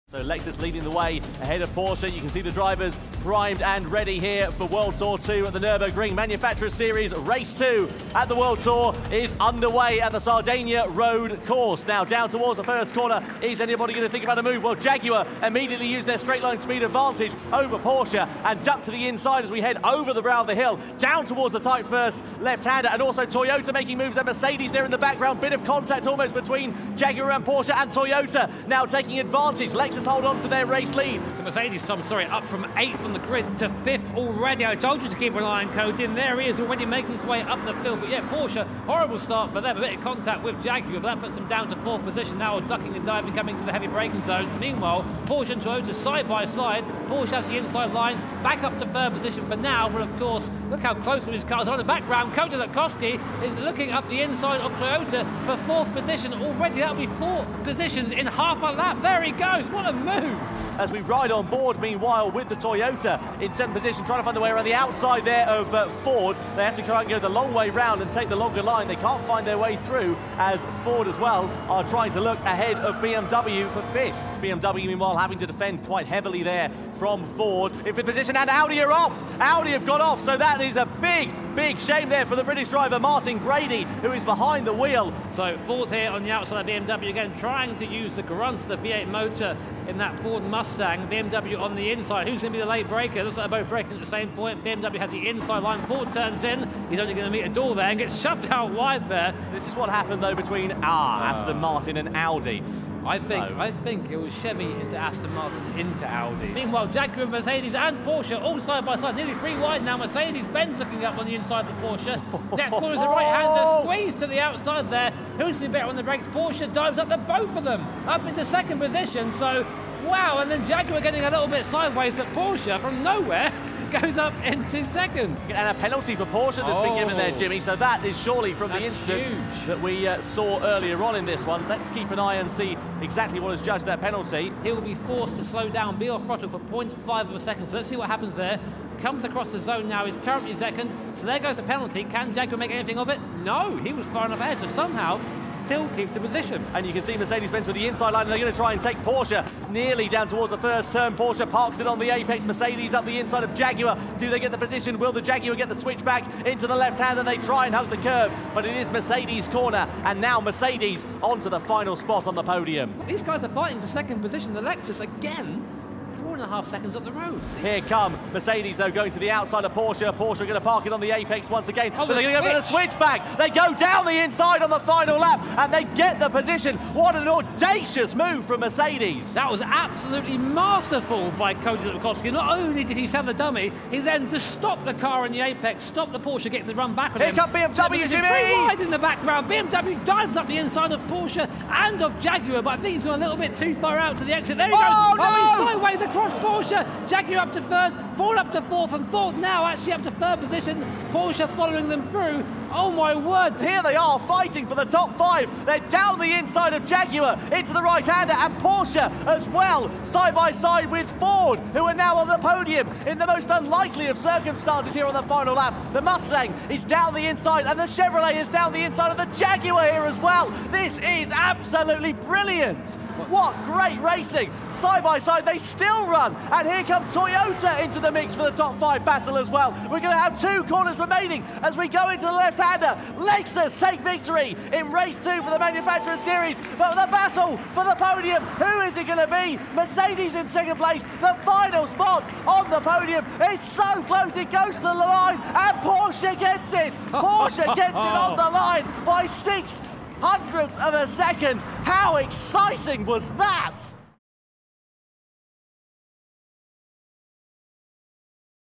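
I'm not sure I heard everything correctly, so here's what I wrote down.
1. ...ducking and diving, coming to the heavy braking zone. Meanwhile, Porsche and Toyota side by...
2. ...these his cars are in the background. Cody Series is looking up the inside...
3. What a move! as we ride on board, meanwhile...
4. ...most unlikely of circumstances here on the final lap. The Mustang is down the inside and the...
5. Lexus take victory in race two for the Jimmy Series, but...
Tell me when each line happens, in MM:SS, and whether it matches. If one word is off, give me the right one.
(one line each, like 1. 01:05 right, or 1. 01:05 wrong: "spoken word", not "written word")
1. 00:42 right
2. 00:51 wrong: "Latkowski", not "Series"
3. 00:59 right
4. 03:33 right
5. 03:53 wrong: "Manufacturer", not "Jimmy".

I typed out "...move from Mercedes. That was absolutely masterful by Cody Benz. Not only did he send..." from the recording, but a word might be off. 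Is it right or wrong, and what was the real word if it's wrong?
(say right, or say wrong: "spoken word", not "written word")
wrong: "Latkowski", not "Benz".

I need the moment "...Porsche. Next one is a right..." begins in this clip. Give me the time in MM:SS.
01:51.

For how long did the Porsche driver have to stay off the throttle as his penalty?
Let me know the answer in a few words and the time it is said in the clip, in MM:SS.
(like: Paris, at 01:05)
0.5 of a second, at 02:16.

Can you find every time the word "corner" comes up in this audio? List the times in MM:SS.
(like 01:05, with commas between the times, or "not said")
00:12, 02:39, 03:50.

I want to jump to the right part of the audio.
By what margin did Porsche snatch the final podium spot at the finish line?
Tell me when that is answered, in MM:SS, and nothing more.
04:09.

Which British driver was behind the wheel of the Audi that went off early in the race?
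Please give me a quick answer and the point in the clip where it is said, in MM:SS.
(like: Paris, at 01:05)
Martin Grady, at 01:22.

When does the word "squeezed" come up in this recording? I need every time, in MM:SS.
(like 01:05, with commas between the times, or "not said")
01:53.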